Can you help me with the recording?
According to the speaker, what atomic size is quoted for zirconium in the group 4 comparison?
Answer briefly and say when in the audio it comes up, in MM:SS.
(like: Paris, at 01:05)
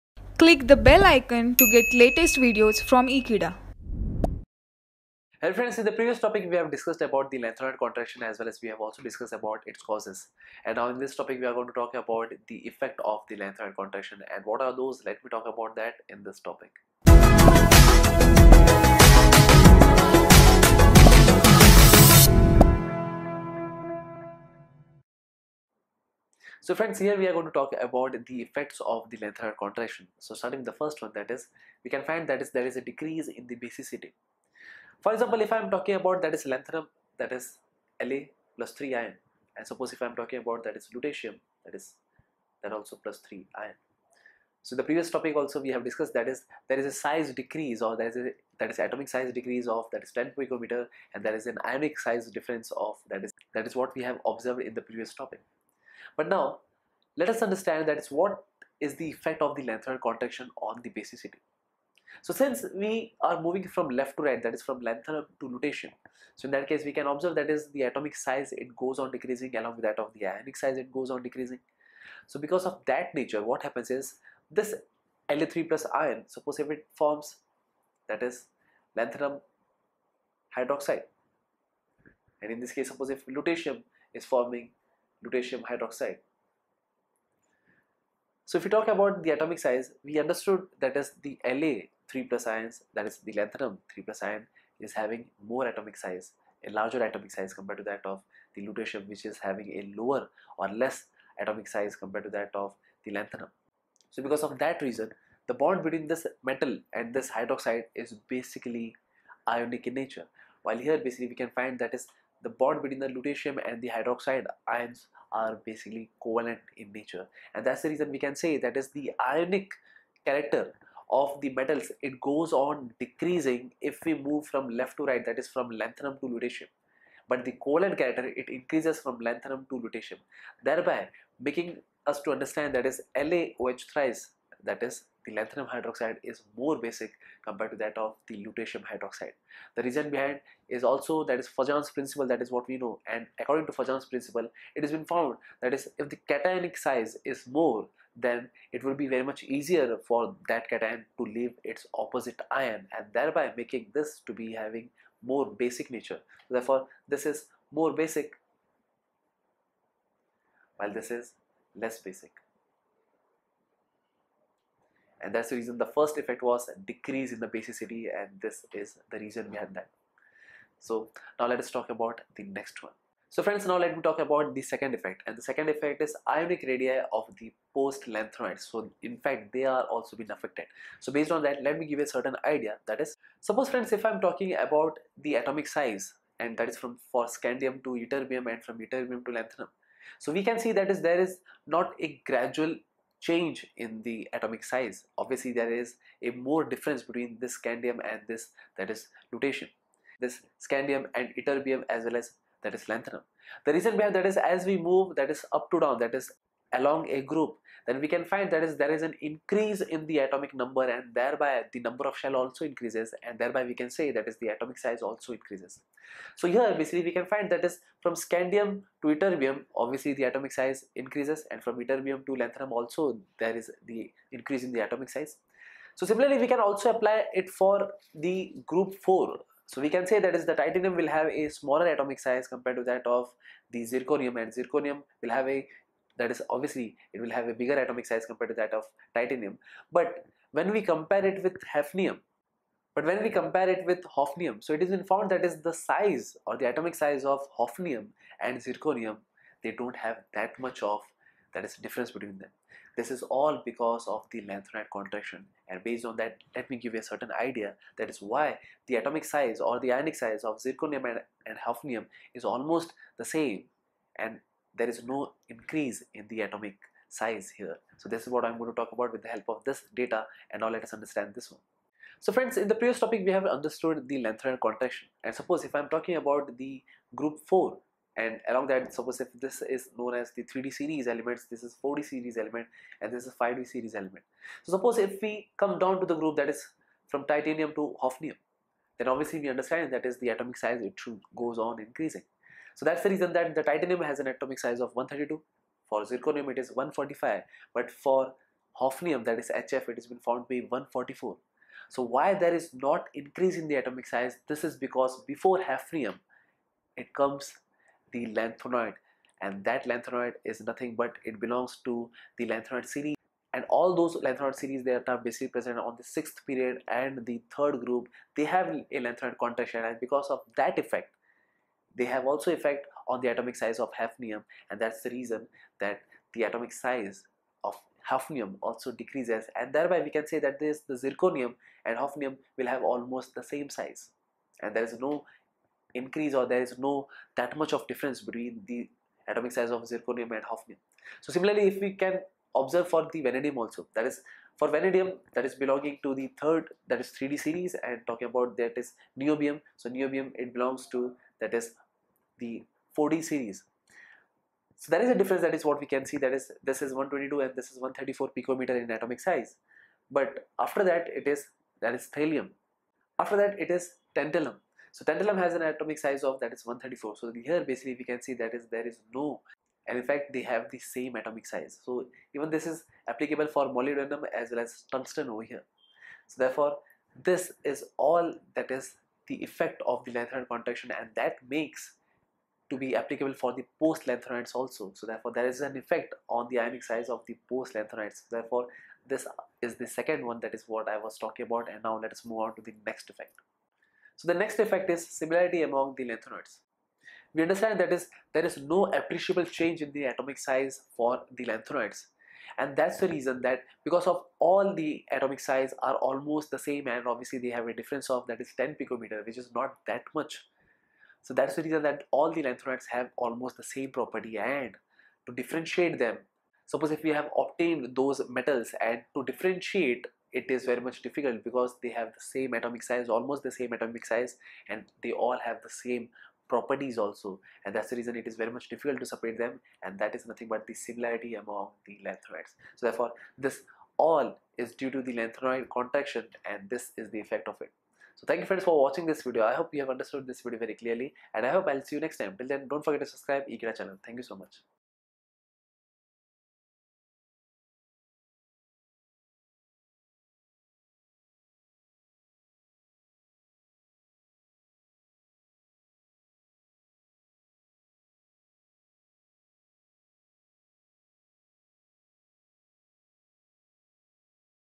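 145, at 04:56.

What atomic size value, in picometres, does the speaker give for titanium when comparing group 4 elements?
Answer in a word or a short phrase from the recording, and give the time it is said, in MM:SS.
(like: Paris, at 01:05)
132, at 04:54.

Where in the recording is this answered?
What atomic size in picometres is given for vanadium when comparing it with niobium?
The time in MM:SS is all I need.
05:56.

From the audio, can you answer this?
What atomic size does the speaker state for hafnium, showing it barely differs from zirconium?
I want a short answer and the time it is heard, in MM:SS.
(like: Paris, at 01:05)
144, at 05:00.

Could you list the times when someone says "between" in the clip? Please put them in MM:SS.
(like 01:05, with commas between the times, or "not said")
01:45, 01:52, 03:17, 04:12, 05:38.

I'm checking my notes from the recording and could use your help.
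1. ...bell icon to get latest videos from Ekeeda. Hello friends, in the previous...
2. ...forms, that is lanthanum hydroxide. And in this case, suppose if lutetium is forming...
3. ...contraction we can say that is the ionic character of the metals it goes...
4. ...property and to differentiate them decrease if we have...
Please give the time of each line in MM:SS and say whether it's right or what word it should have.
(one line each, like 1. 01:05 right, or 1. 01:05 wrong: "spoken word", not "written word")
1. 00:00 right
2. 01:16 right
3. 01:57 wrong: "reason", not "contraction"
4. 06:53 wrong: "suppose", not "decrease".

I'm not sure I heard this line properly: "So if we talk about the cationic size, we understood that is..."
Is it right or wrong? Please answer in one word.
wrong.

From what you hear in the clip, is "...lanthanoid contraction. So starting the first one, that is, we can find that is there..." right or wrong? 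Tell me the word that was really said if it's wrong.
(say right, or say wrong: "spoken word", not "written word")
right.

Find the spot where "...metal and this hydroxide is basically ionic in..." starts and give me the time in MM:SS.
01:46.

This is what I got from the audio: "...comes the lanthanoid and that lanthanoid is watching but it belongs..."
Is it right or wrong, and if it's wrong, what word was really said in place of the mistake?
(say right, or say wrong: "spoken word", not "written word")
wrong: "nothing", not "watching".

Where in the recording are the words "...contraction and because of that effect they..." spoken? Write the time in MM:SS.
05:19.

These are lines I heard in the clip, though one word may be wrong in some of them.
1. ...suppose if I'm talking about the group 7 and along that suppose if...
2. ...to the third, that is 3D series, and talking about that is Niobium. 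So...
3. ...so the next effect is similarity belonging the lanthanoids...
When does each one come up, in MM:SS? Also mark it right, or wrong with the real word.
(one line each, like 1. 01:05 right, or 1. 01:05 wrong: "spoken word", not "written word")
1. 04:35 wrong: "4", not "7"
2. 05:46 right
3. 06:34 wrong: "among", not "belonging".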